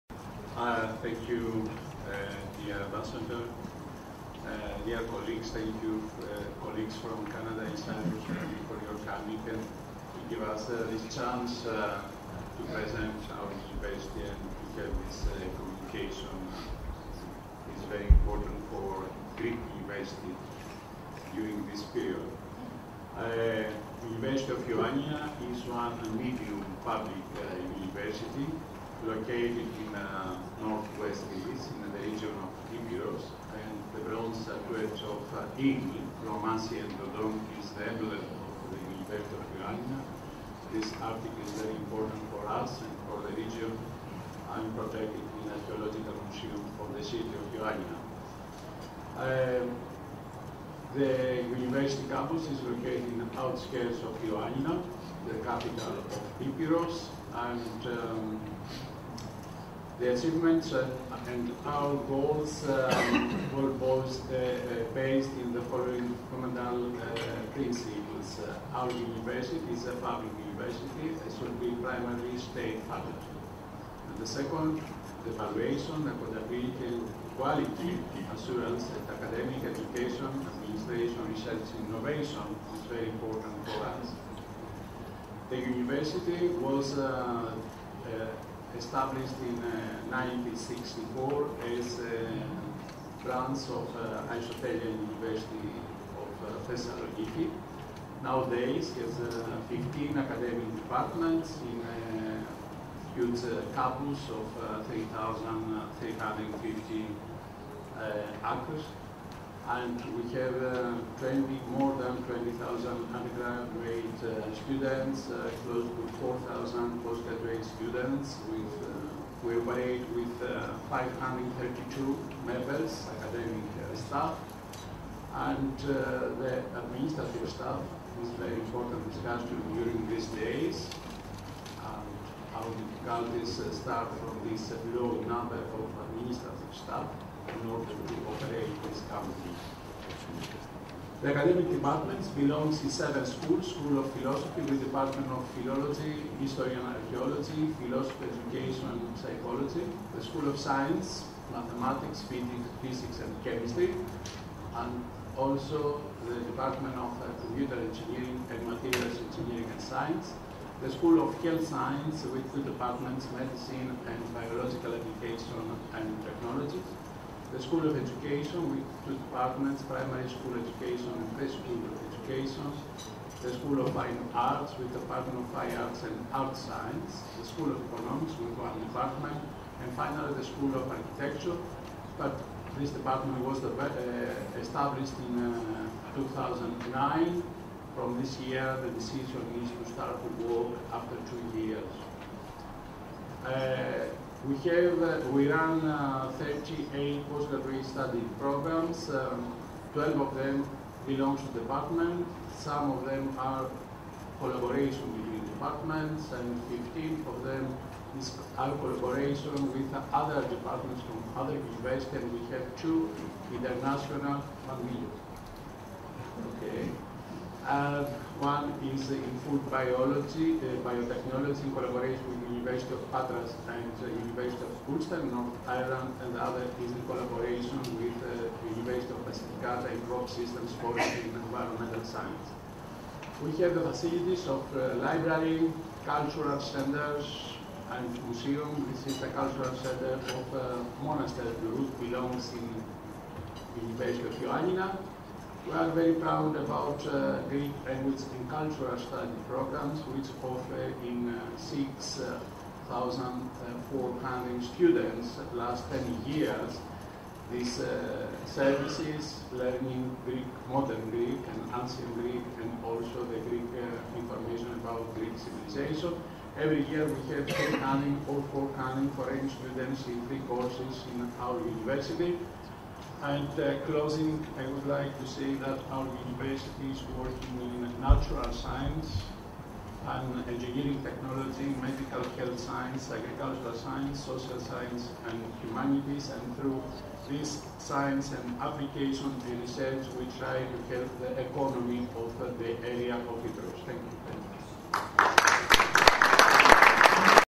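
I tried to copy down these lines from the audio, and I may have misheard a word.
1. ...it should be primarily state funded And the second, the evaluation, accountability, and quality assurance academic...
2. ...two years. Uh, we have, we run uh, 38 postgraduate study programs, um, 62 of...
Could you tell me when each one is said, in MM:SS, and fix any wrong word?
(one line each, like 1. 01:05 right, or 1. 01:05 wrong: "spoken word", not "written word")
1. 01:11 right
2. 03:11 wrong: "12", not "62".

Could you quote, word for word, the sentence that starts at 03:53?
We have the facilities of uh, library, cultural centers, and museum.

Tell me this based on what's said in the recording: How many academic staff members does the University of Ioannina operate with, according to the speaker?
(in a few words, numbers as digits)
532.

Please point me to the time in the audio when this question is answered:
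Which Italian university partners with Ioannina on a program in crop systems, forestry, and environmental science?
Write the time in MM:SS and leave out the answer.
03:48.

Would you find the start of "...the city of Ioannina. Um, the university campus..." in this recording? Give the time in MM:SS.
00:46.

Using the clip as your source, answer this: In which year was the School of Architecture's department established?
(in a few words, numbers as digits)
2009.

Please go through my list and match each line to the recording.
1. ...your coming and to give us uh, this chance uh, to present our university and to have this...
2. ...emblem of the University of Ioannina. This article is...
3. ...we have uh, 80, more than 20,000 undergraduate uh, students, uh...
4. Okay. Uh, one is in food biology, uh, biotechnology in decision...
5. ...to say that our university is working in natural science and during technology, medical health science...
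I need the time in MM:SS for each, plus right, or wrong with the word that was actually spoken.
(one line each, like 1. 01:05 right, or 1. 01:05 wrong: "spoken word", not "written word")
1. 00:08 right
2. 00:37 right
3. 01:50 wrong: "20", not "80"
4. 03:36 wrong: "collaboration", not "decision"
5. 04:35 wrong: "engineering", not "during".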